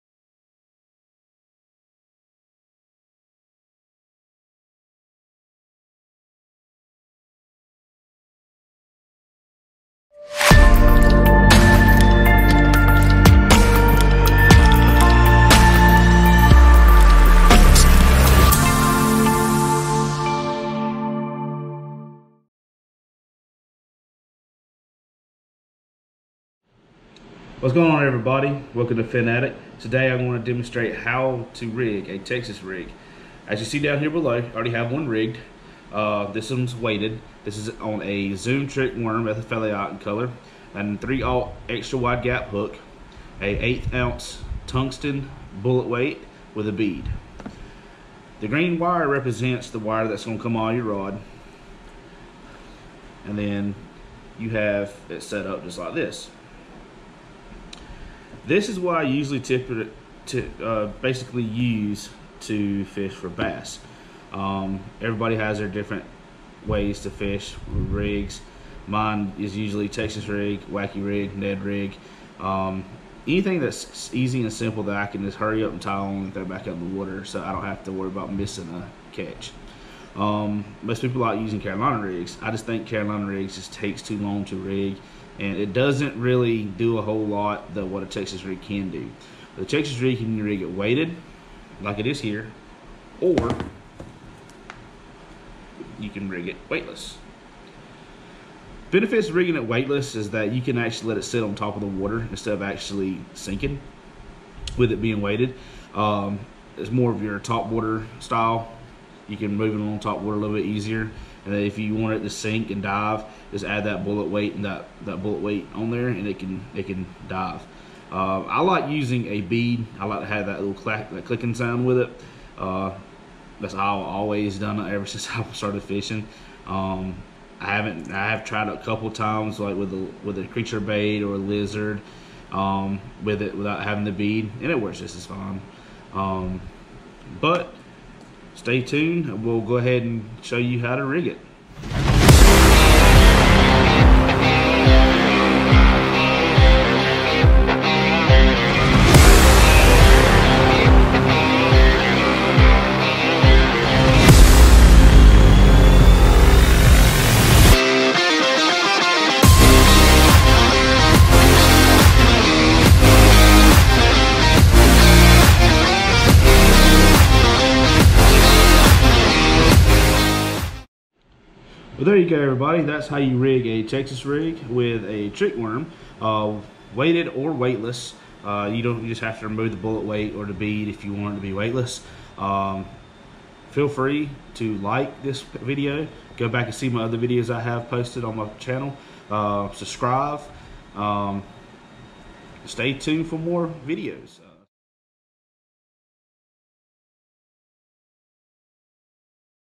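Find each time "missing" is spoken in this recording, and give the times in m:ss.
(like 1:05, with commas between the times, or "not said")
1:18.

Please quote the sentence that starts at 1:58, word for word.
Uh, I like using a bead.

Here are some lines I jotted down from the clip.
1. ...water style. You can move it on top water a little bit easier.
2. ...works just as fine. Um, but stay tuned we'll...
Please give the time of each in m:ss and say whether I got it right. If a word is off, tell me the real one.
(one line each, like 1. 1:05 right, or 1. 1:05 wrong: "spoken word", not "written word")
1. 1:47 right
2. 2:14 right.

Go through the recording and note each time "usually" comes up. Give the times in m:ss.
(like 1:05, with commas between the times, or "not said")
0:59, 1:09.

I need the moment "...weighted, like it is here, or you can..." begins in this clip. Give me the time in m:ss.
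1:30.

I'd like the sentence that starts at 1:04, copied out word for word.
Um, everybody has their different ways to fish rigs.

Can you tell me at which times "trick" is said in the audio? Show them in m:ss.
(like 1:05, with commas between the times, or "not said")
0:38, 2:55.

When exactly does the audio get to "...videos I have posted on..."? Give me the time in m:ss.
3:07.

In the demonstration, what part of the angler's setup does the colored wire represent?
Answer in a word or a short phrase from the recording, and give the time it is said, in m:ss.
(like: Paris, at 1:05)
your rod, at 0:50.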